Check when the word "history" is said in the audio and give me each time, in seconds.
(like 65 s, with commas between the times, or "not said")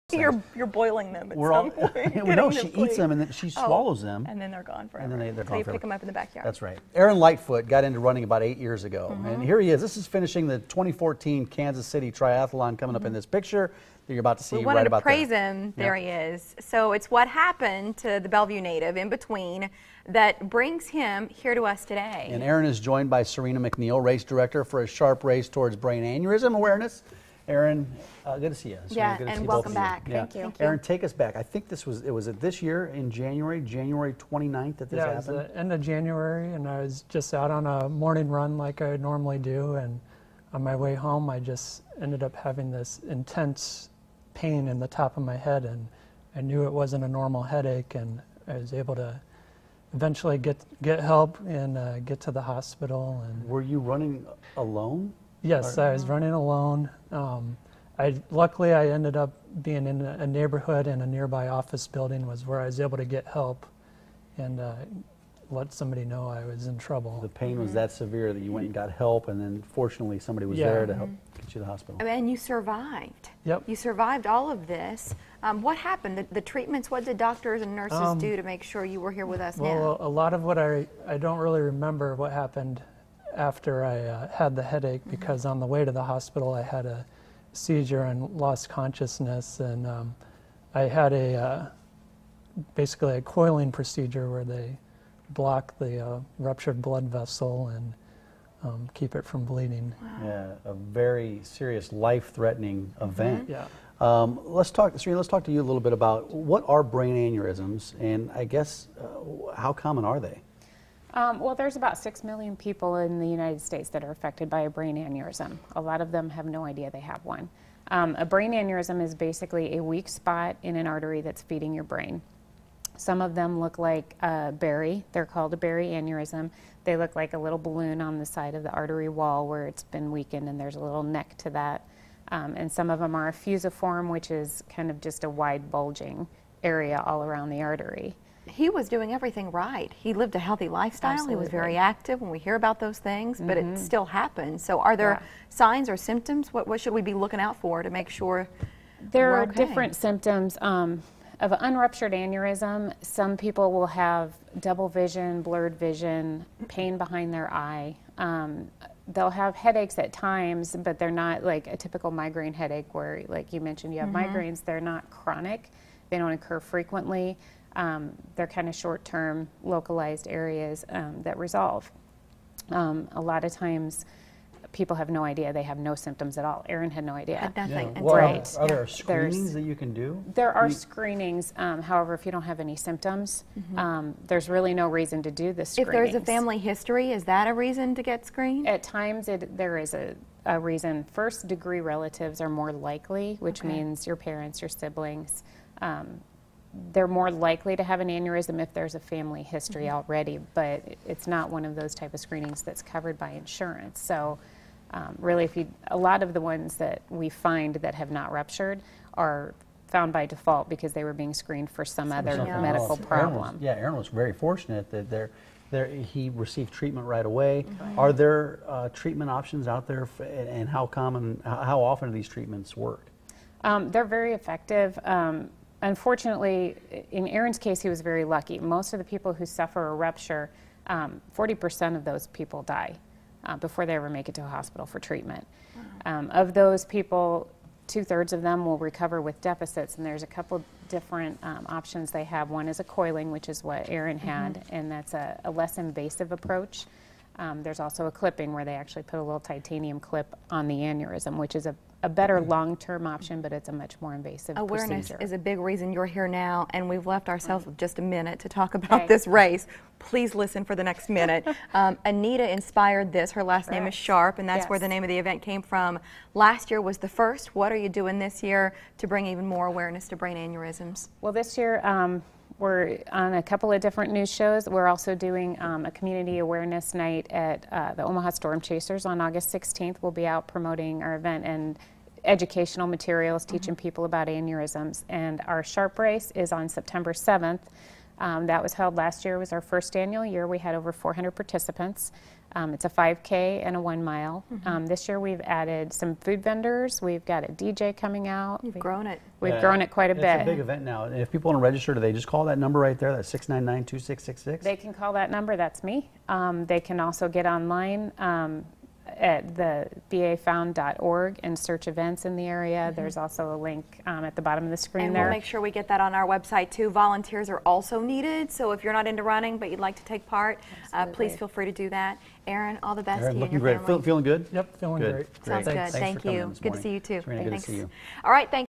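186 s, 199 s.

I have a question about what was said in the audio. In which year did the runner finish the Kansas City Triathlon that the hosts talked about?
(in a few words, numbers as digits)
2014.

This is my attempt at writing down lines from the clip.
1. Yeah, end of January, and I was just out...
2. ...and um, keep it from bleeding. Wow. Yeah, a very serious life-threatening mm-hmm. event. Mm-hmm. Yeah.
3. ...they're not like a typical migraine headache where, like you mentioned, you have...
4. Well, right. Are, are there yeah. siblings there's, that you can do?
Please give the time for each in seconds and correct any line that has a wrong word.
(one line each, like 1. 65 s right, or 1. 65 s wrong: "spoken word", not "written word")
1. 35 s right
2. 97 s right
3. 160 s right
4. 178 s wrong: "screenings", not "siblings".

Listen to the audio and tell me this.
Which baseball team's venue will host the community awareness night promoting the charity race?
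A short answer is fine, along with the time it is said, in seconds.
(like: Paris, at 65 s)
Omaha Storm Chasers, at 278 s.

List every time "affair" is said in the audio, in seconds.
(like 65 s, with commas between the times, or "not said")
not said.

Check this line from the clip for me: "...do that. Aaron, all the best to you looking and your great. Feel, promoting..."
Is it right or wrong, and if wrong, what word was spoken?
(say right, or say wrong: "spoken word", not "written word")
wrong: "feeling", not "promoting".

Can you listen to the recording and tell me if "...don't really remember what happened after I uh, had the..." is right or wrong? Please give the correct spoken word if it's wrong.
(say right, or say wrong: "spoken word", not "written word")
right.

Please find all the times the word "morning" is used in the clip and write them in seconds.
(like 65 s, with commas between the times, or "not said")
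37 s, 326 s.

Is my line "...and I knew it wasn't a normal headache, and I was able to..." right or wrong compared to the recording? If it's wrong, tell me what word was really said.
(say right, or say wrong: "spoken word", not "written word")
right.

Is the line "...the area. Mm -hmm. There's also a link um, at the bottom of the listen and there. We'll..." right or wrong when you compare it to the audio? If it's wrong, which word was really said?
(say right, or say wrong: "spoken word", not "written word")
wrong: "screen", not "listen".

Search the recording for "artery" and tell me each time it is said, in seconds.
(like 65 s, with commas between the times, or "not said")
120 s, 128 s, 137 s.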